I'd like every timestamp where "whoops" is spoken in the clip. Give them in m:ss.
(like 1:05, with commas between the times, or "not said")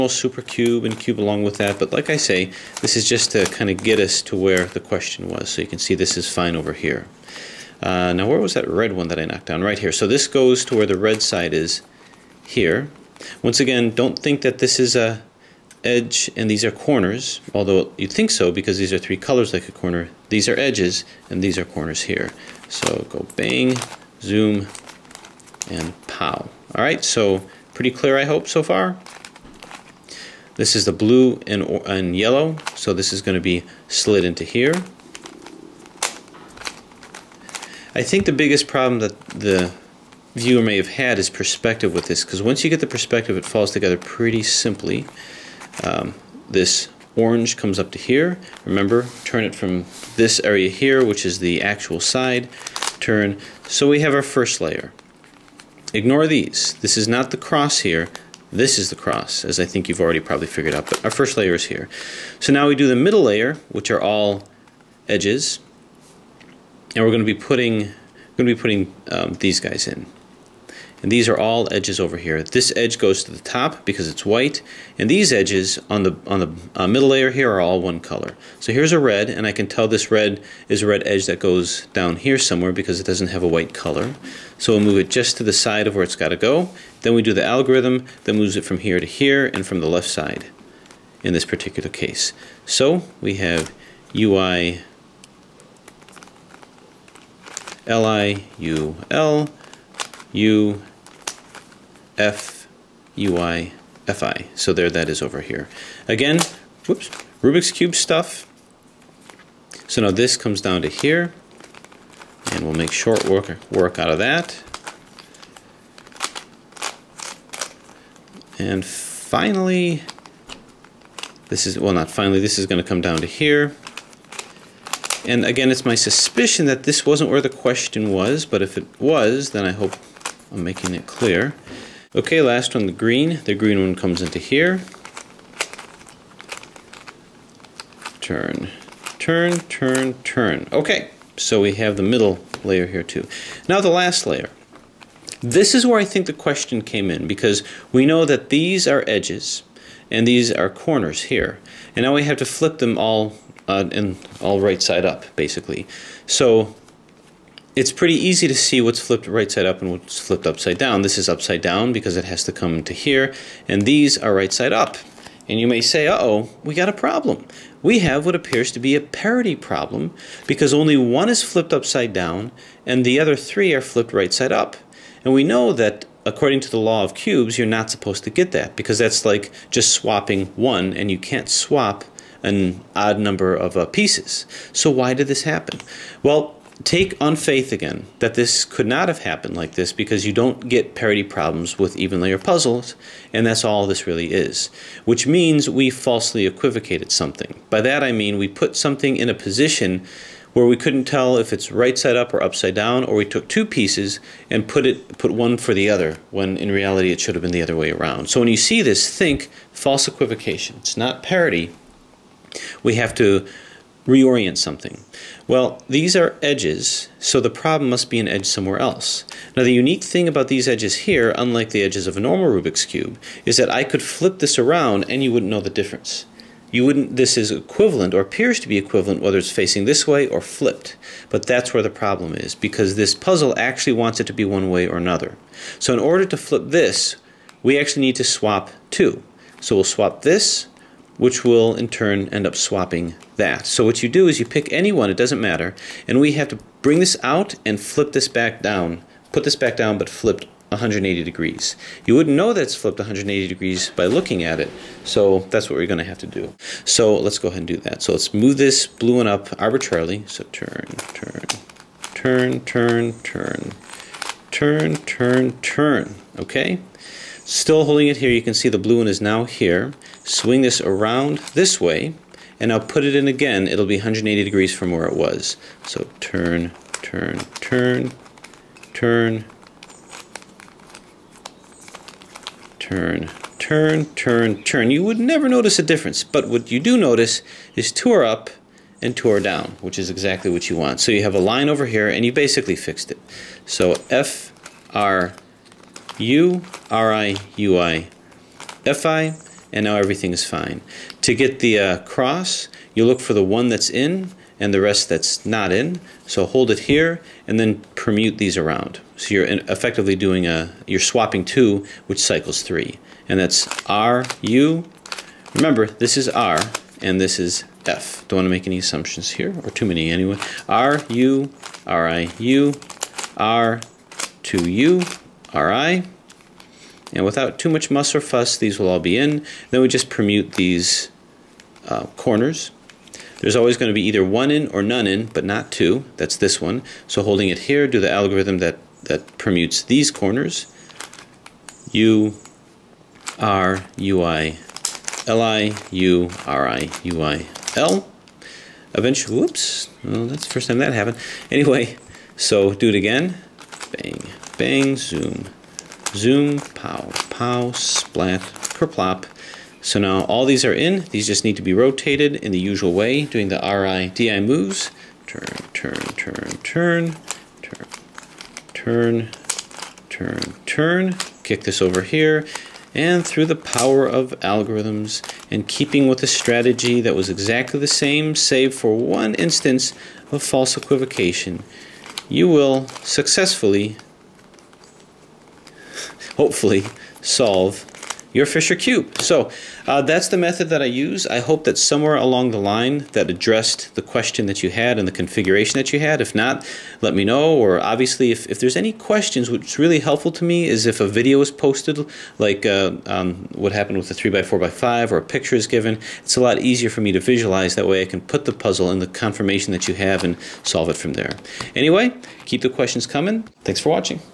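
1:46, 5:49.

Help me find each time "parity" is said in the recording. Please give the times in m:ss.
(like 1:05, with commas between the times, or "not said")
2:49, 3:10, 3:31.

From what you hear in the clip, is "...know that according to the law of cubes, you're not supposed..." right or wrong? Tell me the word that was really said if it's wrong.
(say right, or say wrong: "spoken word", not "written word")
right.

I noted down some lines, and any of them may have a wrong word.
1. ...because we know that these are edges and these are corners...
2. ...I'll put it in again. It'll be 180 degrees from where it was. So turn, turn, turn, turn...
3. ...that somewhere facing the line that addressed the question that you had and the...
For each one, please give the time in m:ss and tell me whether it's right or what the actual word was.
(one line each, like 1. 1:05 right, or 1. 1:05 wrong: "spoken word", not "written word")
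1. 2:27 right
2. 4:32 right
3. 6:31 wrong: "along", not "facing".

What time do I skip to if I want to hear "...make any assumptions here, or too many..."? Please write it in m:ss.
5:18.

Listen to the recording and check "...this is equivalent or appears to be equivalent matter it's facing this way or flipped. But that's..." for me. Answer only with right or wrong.
wrong.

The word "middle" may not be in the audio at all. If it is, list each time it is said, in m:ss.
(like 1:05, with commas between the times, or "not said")
1:02, 1:16, 2:22.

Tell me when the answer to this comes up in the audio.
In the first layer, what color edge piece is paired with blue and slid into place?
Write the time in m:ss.
0:32.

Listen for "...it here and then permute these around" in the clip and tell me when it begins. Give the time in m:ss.
5:06.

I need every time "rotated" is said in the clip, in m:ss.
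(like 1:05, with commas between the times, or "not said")
6:01.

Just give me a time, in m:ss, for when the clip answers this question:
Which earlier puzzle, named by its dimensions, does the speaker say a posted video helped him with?
6:44.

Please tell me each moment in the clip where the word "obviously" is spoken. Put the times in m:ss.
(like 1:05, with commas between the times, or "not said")
6:37.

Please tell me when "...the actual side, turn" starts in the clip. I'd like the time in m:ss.
0:51.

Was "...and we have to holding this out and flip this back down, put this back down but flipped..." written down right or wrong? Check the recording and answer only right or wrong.
wrong.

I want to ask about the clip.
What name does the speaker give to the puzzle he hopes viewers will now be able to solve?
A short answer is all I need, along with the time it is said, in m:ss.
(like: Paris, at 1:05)
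Fisher cube, at 6:28.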